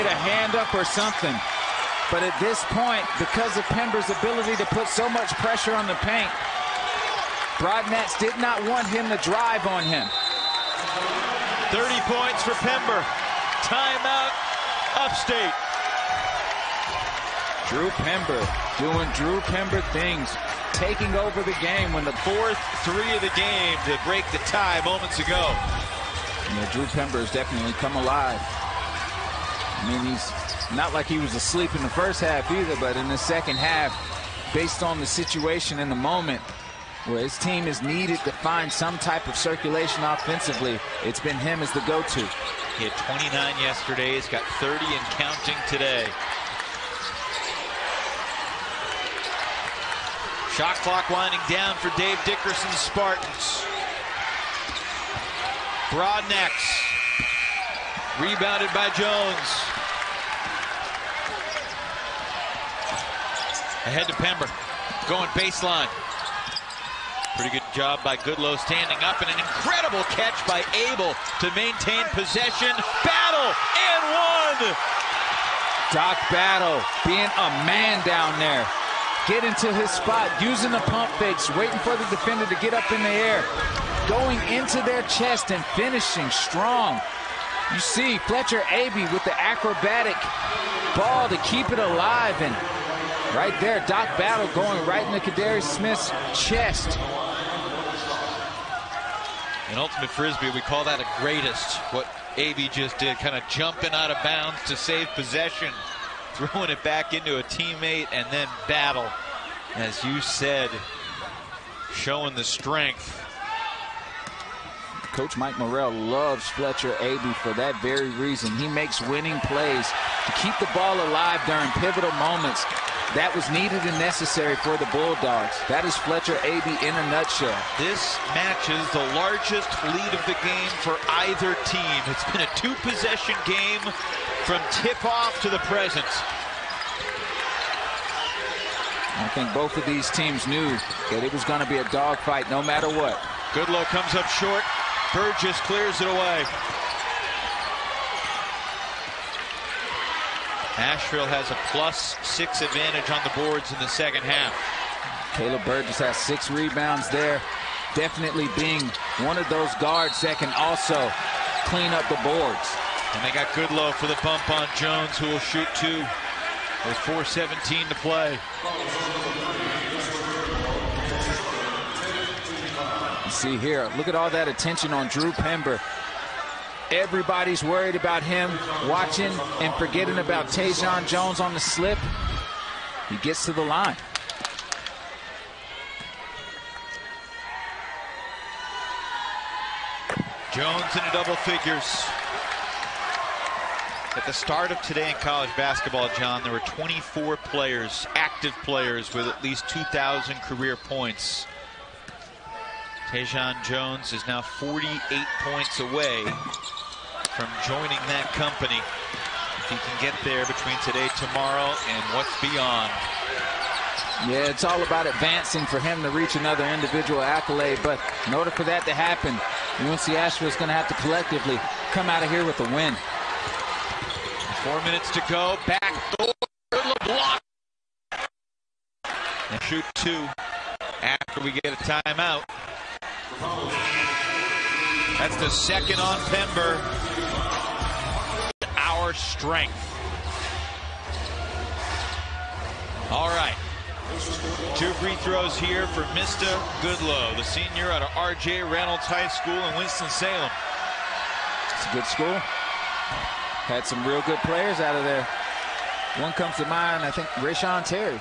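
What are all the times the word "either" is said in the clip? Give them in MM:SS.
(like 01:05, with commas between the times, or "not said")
00:32, 02:11.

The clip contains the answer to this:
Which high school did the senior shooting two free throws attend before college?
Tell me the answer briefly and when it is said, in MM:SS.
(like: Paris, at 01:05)
R.J. Reynolds High School, at 04:08.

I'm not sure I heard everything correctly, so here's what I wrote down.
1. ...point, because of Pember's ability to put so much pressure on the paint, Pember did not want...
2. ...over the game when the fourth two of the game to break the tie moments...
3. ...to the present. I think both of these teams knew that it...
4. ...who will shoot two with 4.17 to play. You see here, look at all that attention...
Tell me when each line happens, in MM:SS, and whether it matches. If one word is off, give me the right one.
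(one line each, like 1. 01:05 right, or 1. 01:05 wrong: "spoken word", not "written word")
1. 00:02 wrong: "Broadnax", not "Pember"
2. 00:21 wrong: "three", not "two"
3. 02:15 right
4. 02:45 right.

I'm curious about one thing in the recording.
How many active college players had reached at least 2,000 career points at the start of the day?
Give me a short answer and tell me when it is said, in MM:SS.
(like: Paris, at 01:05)
24, at 03:16.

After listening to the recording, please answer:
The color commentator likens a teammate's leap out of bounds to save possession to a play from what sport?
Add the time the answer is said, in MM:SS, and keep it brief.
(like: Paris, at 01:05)
Ultimate Frisbee, at 01:39.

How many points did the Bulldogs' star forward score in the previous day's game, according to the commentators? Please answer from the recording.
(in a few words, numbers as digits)
29.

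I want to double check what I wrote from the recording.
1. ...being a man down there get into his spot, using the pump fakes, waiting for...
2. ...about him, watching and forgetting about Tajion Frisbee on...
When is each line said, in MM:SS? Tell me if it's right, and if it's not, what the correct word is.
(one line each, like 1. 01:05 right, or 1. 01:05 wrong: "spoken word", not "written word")
1. 01:17 right
2. 02:57 wrong: "Jones", not "Frisbee".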